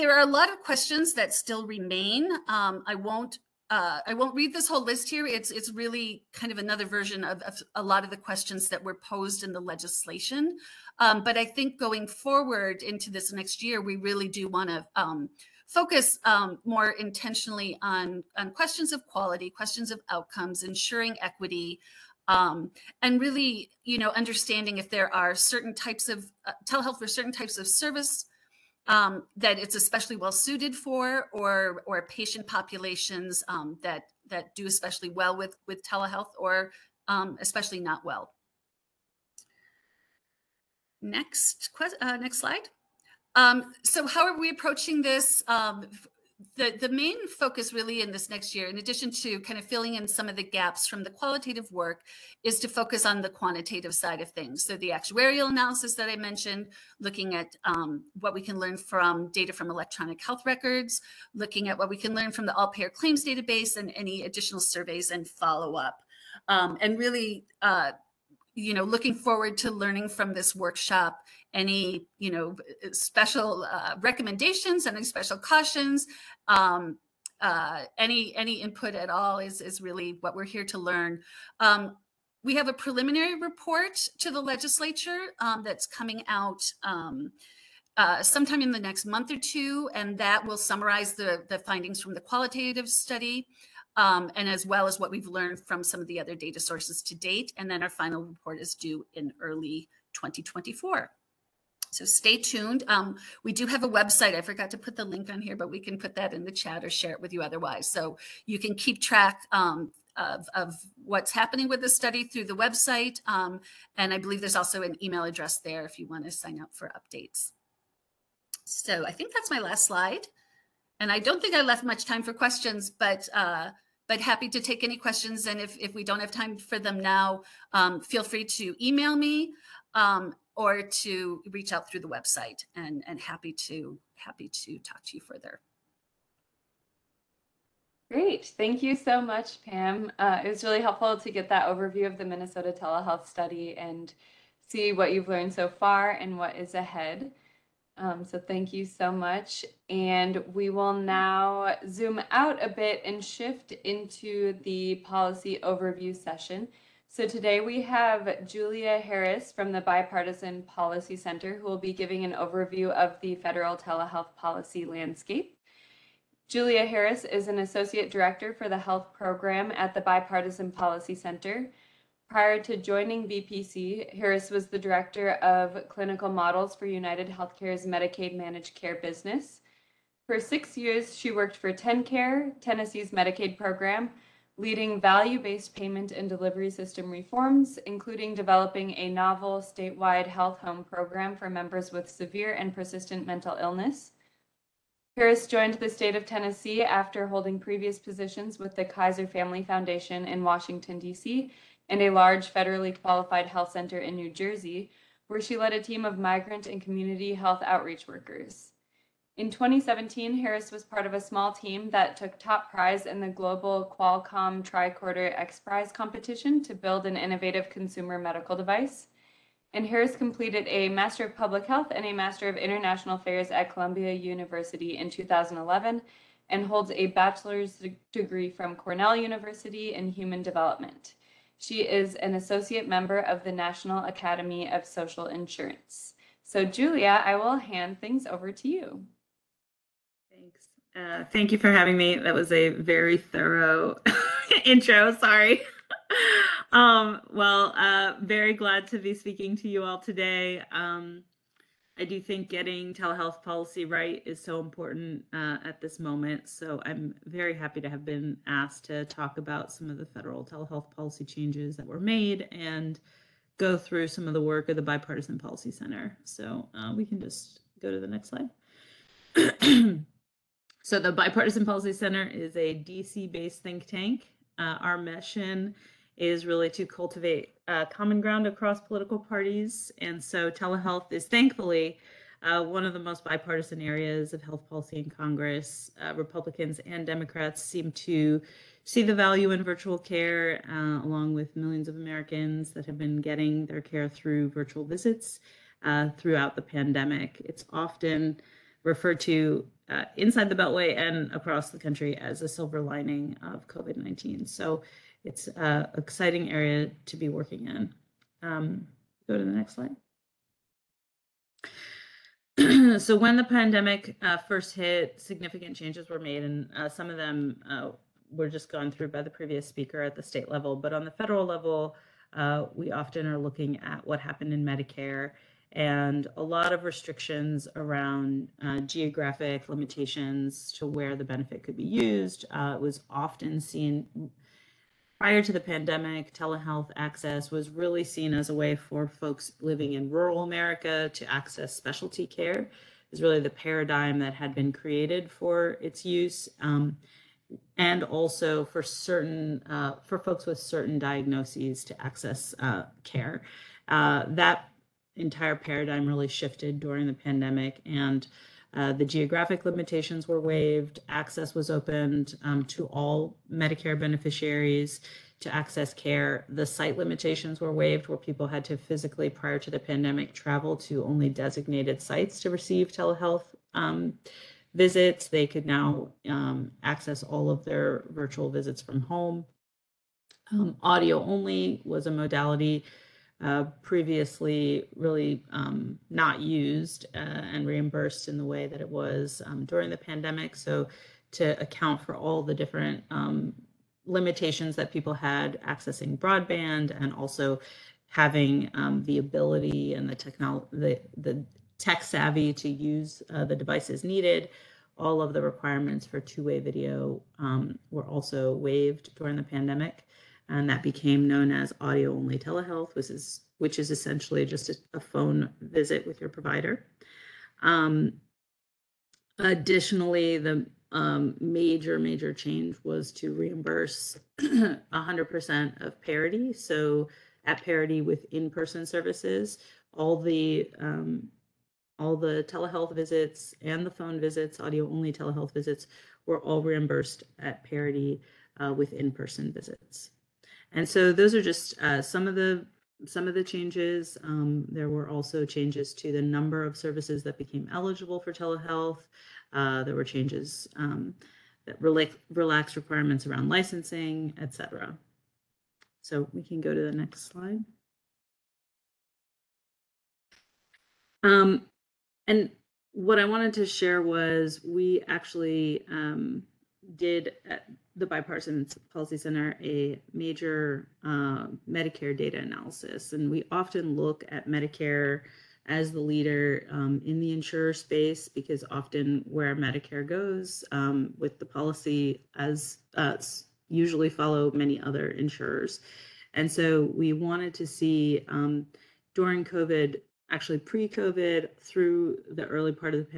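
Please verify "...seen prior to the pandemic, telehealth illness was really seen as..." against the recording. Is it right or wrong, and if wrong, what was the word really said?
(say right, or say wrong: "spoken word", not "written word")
wrong: "access", not "illness".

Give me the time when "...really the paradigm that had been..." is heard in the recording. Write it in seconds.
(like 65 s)
343 s.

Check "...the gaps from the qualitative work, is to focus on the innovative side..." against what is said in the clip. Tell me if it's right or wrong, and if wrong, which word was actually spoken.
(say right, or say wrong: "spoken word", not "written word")
wrong: "quantitative", not "innovative".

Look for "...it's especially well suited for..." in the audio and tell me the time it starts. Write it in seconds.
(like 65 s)
29 s.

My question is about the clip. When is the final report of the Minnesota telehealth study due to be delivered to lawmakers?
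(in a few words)
early 2024.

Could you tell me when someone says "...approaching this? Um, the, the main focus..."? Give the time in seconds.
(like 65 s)
44 s.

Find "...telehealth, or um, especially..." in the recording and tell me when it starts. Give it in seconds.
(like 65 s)
35 s.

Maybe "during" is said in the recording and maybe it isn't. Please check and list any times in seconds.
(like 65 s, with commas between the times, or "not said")
356 s, 389 s, 409 s, 489 s.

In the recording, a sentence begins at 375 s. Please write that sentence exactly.
They could now um, access all of their virtual visits from home.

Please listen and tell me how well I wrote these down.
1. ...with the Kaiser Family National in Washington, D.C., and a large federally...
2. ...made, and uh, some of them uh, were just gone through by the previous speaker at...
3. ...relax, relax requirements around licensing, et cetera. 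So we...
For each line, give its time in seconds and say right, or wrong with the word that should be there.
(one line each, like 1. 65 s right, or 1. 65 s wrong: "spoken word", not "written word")
1. 198 s wrong: "Foundation", not "National"
2. 316 s right
3. 451 s right.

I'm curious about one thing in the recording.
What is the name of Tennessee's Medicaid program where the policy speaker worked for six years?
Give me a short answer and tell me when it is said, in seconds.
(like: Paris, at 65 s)
TenCare, at 181 s.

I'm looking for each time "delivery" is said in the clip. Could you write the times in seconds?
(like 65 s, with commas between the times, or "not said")
186 s.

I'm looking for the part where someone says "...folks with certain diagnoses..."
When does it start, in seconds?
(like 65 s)
350 s.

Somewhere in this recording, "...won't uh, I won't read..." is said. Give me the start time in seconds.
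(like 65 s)
2 s.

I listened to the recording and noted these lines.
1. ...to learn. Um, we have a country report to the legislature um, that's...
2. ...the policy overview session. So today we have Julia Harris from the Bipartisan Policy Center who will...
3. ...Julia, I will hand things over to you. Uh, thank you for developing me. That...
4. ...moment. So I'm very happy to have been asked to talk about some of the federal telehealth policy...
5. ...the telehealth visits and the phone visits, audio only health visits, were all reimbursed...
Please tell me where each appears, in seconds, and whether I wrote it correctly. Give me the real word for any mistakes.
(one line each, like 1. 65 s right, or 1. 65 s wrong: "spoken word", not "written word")
1. 80 s wrong: "preliminary", not "country"
2. 154 s right
3. 236 s wrong: "having", not "developing"
4. 255 s right
5. 432 s wrong: "telehealth", not "health".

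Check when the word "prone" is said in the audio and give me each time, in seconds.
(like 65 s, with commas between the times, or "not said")
not said.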